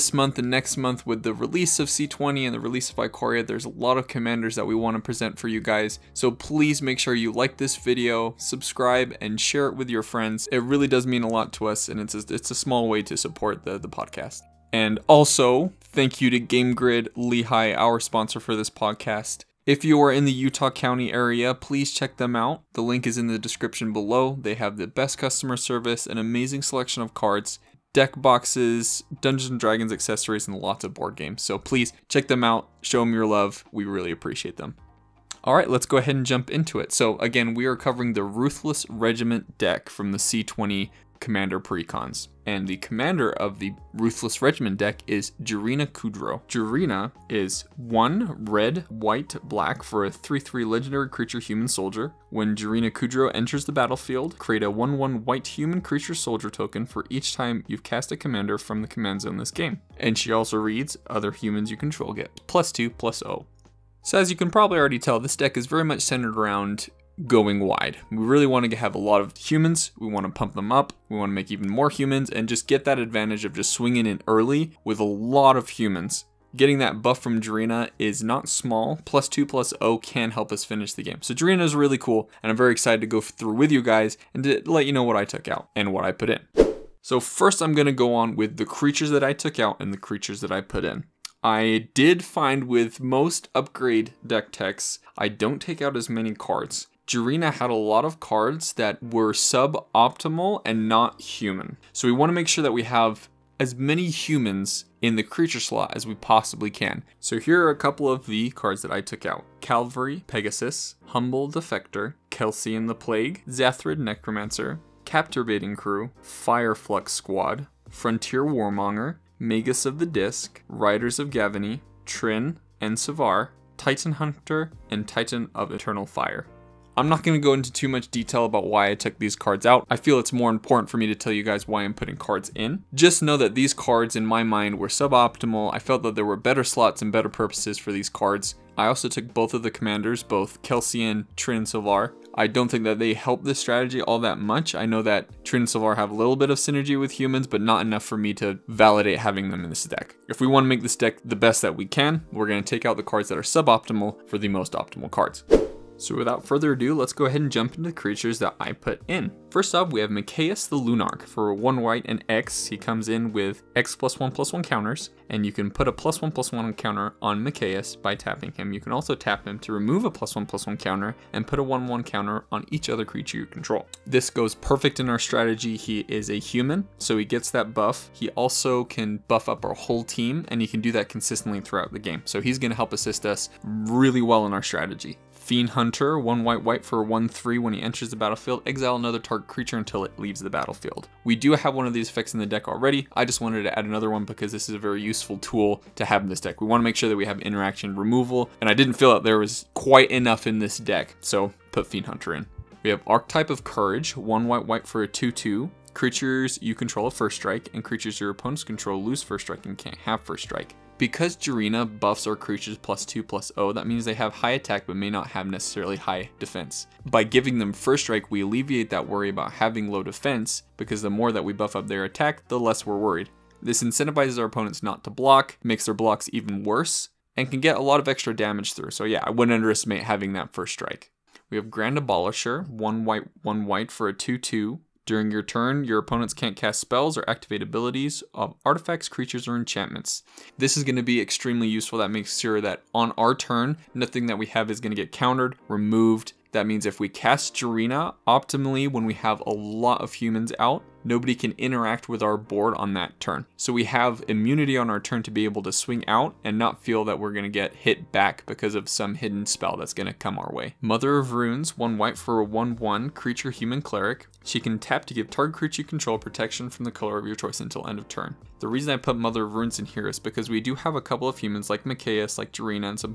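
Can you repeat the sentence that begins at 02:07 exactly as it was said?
I'm not going to go into too much detail about why I took these cards out.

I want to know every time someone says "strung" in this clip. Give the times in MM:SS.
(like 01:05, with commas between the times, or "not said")
not said.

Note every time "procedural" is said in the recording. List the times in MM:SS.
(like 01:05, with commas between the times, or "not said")
not said.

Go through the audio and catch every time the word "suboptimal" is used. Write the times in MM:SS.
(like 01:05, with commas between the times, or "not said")
01:39, 02:14, 02:33.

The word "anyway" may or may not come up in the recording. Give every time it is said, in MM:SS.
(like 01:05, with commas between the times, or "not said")
not said.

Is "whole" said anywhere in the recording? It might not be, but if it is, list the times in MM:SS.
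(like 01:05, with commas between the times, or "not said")
02:59.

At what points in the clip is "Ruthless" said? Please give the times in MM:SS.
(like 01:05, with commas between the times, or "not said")
00:38, 00:43.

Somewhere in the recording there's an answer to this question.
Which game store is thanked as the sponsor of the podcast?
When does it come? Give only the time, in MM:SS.
00:16.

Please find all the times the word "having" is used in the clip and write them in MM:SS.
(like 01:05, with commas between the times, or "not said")
02:29, 03:39, 03:50.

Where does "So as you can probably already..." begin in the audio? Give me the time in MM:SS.
01:04.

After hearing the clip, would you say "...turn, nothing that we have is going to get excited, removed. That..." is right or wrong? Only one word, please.
wrong.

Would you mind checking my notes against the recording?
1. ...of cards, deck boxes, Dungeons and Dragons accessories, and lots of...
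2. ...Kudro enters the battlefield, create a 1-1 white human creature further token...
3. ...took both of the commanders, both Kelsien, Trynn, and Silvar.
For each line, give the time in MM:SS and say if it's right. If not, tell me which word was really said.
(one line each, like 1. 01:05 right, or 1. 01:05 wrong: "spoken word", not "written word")
1. 00:27 right
2. 00:52 wrong: "soldier", not "further"
3. 02:19 right.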